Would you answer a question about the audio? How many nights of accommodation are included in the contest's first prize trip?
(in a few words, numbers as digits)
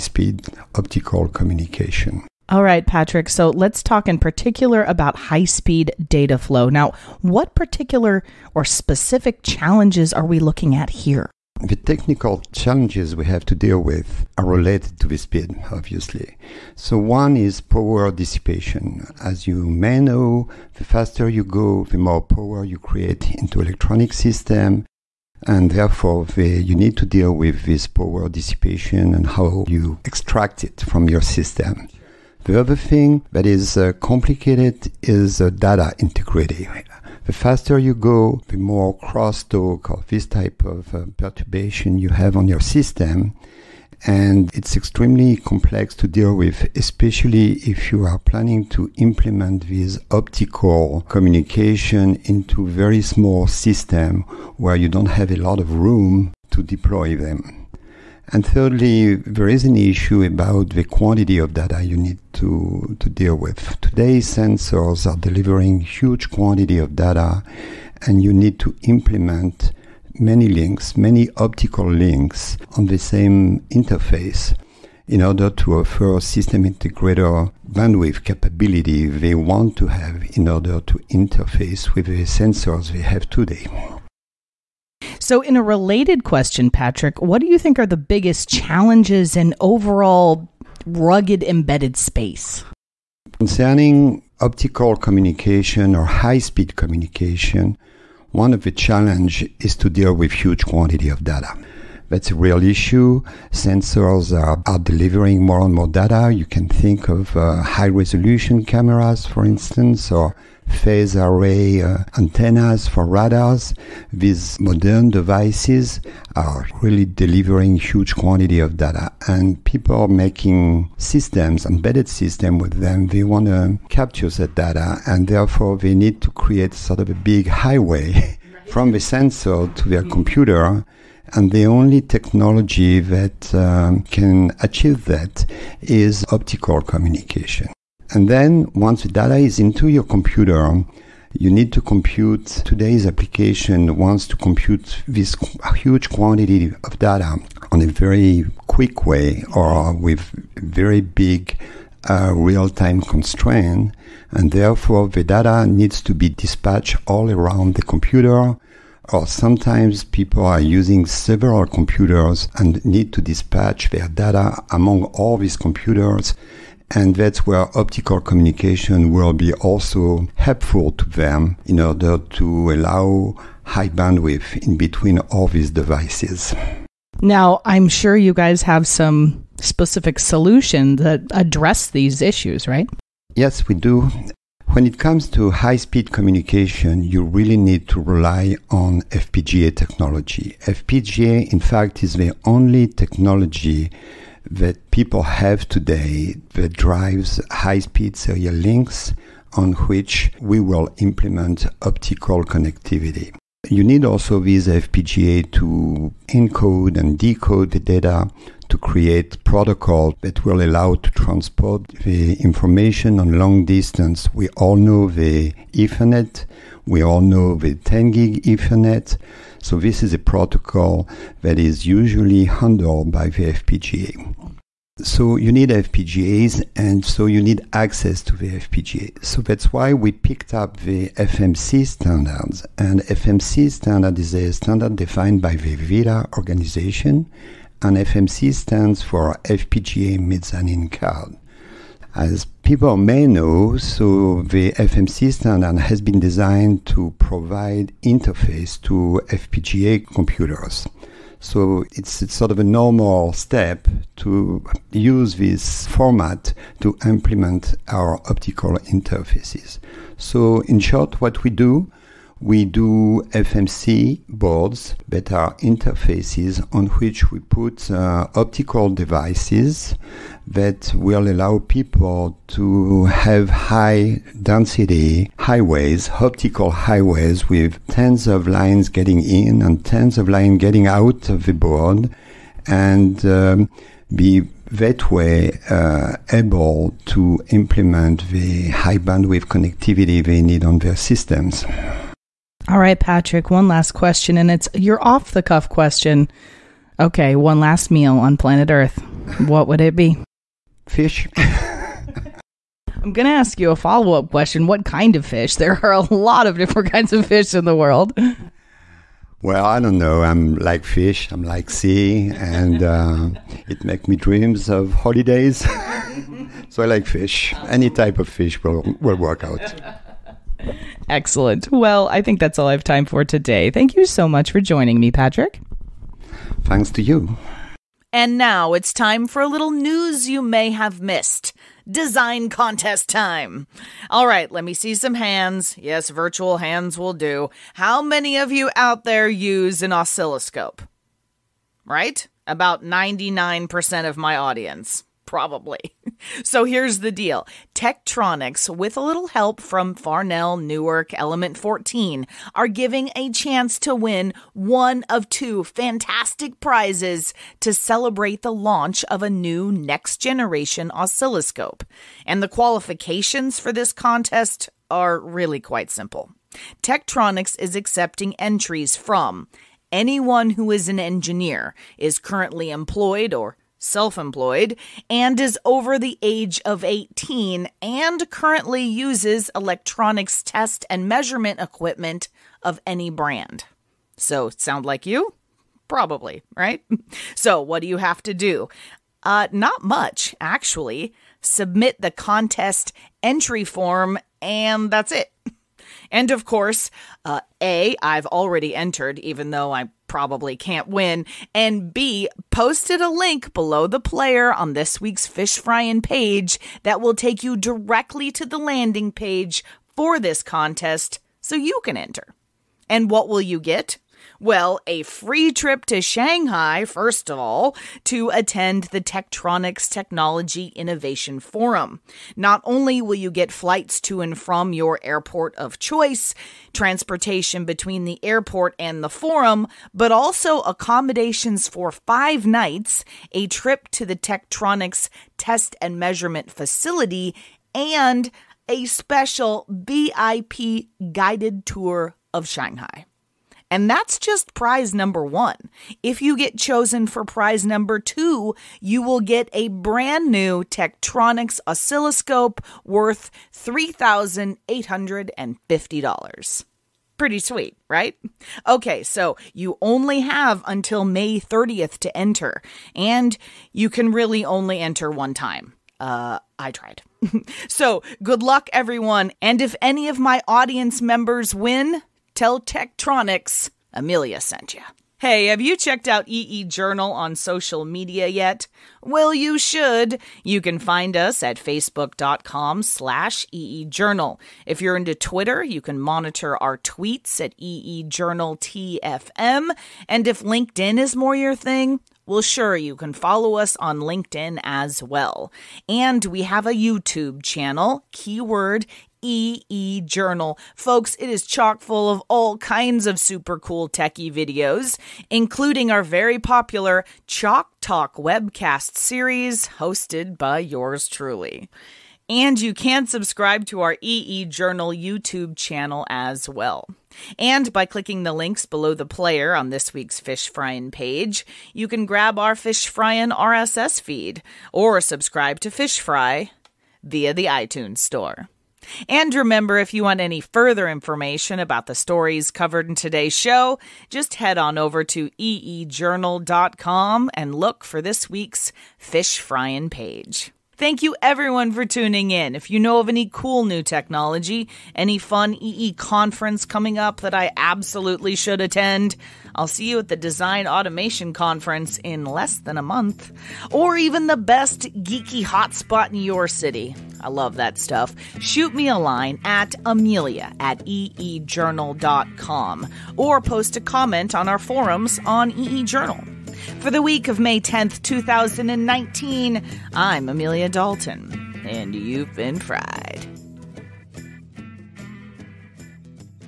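5.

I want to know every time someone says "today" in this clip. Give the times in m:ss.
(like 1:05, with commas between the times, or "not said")
1:03, 1:23, 2:22, 3:15, 5:23, 8:52.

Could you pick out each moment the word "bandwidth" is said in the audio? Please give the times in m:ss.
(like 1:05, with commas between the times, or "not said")
1:17, 2:53, 4:48.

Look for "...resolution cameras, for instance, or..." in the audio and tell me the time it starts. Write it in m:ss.
1:47.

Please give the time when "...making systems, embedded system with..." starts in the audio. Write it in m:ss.
2:00.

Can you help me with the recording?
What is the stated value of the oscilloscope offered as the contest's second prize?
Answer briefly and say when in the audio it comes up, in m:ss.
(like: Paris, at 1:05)
$3,850, at 7:33.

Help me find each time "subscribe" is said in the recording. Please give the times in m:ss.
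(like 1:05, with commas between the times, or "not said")
8:33, 8:45.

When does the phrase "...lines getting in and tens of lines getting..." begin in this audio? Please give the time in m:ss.
4:38.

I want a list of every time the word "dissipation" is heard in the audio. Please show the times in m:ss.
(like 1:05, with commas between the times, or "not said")
0:18, 0:28.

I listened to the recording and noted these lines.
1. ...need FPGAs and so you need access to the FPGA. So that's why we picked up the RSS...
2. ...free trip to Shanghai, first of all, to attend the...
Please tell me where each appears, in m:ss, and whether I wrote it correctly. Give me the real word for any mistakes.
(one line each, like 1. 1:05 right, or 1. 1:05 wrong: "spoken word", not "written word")
1. 3:45 wrong: "FMC", not "RSS"
2. 6:55 right.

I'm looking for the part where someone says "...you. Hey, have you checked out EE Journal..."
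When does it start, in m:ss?
7:54.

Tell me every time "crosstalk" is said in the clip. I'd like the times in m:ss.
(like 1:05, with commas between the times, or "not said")
0:38.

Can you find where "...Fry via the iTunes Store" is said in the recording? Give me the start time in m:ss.
8:45.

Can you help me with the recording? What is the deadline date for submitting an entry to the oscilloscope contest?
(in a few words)
May 30th.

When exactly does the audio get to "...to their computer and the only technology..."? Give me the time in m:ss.
2:09.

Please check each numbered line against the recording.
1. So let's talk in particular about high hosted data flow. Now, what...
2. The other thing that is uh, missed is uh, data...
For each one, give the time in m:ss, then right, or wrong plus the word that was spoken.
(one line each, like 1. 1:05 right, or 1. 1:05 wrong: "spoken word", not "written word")
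1. 0:03 wrong: "speed", not "hosted"
2. 0:32 wrong: "complicated", not "missed".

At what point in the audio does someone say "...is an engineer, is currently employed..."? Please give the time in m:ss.
6:10.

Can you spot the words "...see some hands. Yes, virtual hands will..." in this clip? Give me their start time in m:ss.
5:34.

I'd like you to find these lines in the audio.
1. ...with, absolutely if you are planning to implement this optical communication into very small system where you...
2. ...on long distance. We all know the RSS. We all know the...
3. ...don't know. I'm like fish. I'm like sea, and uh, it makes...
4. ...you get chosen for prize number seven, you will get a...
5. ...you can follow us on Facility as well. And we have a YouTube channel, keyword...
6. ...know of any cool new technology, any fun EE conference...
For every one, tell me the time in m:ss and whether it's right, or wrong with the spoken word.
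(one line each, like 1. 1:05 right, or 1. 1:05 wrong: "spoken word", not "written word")
1. 0:46 wrong: "especially", not "absolutely"
2. 3:33 wrong: "Ethernet", not "RSS"
3. 5:09 right
4. 7:26 wrong: "two", not "seven"
5. 8:12 wrong: "LinkedIn", not "Facility"
6. 9:02 right.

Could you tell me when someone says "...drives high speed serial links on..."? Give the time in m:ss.
3:16.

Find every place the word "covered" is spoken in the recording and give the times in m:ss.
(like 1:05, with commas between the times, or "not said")
8:52.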